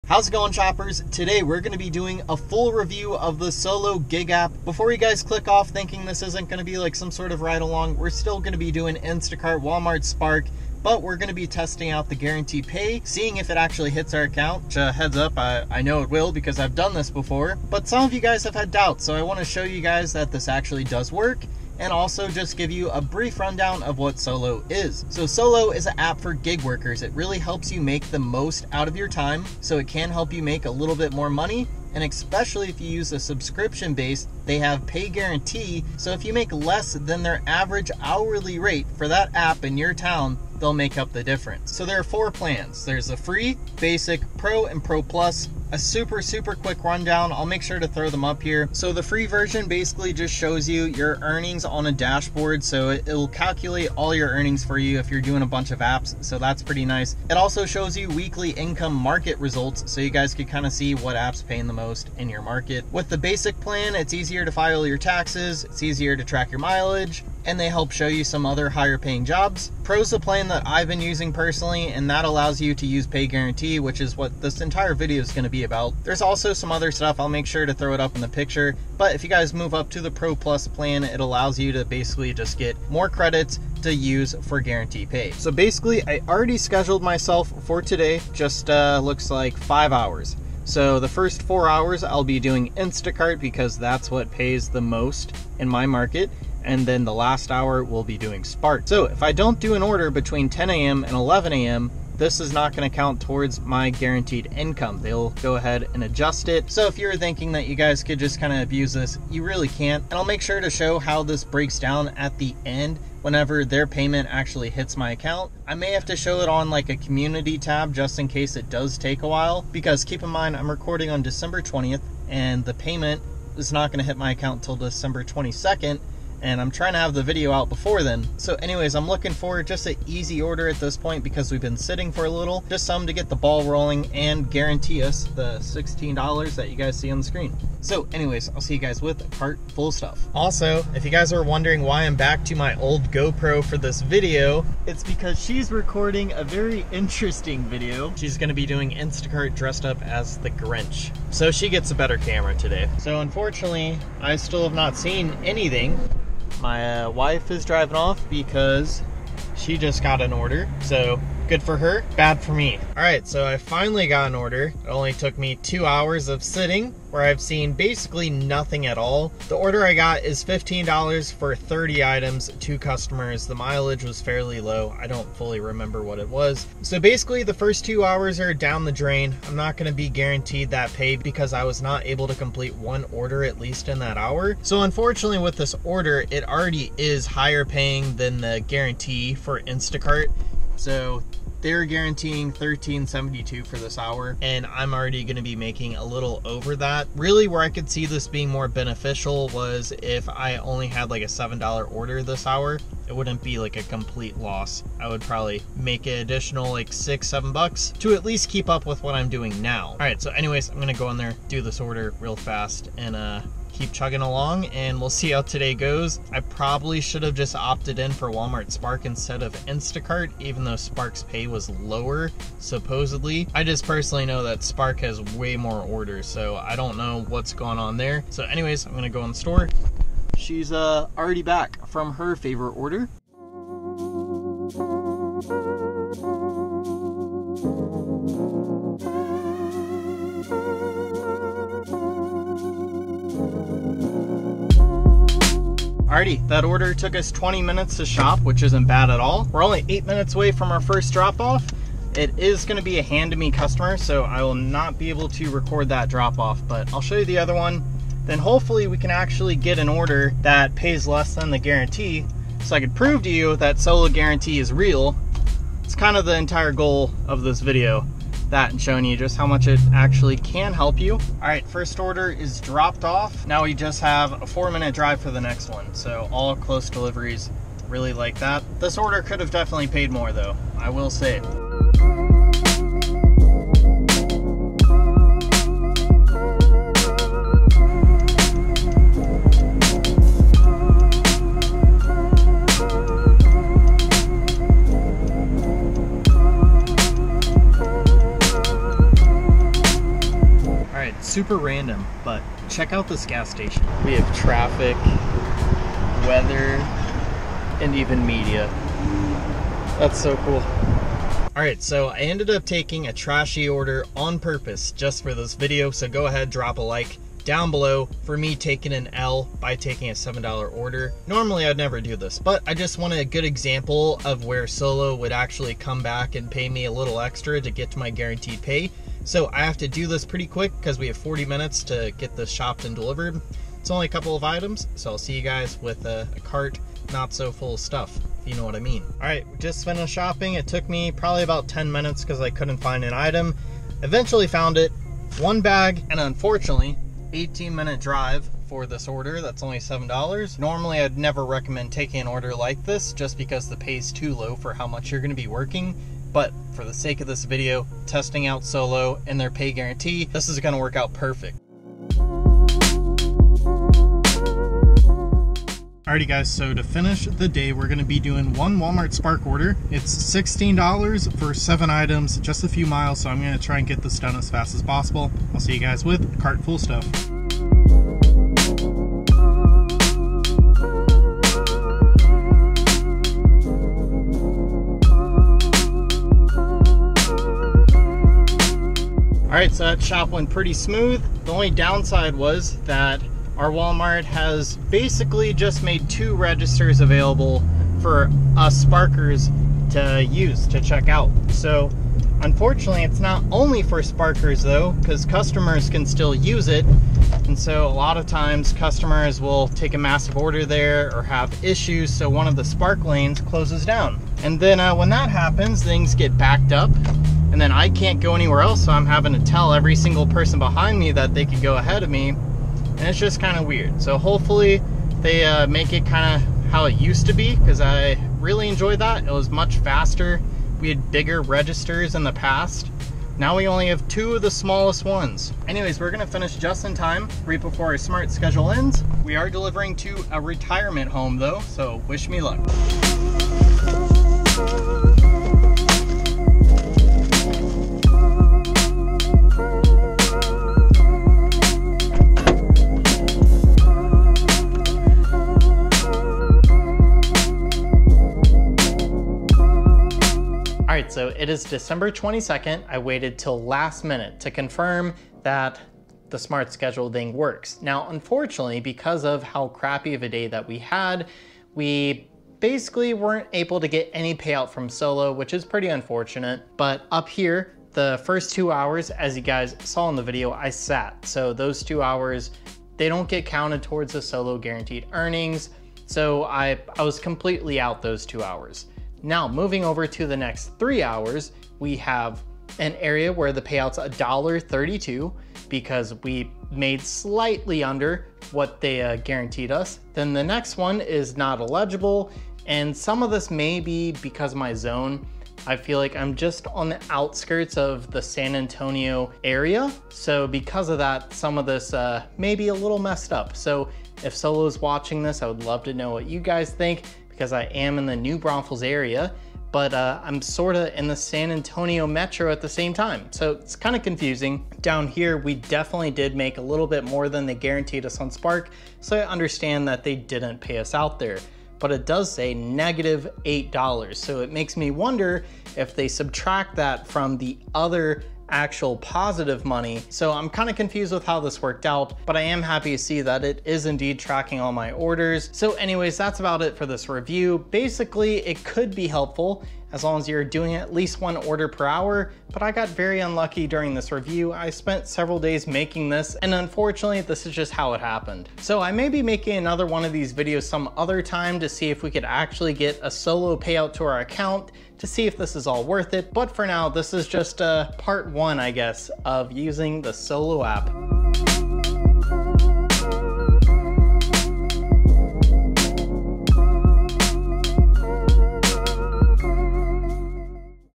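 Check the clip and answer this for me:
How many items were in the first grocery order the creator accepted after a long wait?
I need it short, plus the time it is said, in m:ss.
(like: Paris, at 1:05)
30, at 2:51.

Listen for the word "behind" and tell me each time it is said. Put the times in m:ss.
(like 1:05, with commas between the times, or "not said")
7:00.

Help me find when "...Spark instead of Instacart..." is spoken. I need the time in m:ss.
3:38.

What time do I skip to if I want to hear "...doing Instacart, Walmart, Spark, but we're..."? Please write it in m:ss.
0:08.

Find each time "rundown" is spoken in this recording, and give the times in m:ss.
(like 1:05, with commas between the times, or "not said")
0:23, 0:46.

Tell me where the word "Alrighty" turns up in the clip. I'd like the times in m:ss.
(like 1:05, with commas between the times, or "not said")
4:06, 6:06.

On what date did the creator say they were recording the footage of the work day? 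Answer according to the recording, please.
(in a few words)
December 20th.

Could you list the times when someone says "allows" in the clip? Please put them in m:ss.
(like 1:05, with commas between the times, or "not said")
1:12, 1:21.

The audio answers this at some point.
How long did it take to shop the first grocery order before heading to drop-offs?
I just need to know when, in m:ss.
4:07.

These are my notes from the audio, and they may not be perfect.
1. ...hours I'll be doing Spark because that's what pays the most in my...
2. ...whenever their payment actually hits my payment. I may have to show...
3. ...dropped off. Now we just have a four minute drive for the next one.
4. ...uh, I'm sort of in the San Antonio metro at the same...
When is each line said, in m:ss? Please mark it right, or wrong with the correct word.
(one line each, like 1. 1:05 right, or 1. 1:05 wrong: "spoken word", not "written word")
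1. 1:31 wrong: "Instacart", not "Spark"
2. 1:53 wrong: "account", not "payment"
3. 4:32 right
4. 8:39 right.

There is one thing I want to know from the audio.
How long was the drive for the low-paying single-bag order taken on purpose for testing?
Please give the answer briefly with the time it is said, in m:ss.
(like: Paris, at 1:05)
18 minutes, at 5:47.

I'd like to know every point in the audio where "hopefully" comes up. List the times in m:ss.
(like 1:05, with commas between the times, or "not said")
4:18, 7:04.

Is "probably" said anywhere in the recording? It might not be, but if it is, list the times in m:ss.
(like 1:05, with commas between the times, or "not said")
3:25, 3:36, 5:41.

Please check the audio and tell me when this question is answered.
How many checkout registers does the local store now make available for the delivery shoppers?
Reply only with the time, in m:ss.
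6:36.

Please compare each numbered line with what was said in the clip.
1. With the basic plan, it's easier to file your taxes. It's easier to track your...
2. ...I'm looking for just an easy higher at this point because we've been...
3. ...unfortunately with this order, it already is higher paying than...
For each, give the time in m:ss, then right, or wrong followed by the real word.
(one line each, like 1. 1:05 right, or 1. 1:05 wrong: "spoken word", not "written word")
1. 1:02 right
2. 2:08 wrong: "order", not "higher"
3. 3:04 right.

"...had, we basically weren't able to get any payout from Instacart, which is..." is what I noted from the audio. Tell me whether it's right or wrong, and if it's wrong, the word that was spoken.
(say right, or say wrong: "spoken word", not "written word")
wrong: "Solo", not "Instacart".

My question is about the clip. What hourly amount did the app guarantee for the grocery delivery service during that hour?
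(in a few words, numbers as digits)
$13.72.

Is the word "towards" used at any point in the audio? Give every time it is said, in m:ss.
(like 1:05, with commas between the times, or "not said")
1:43, 8:03.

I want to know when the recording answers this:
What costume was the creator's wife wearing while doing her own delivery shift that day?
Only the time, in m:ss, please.
2:30.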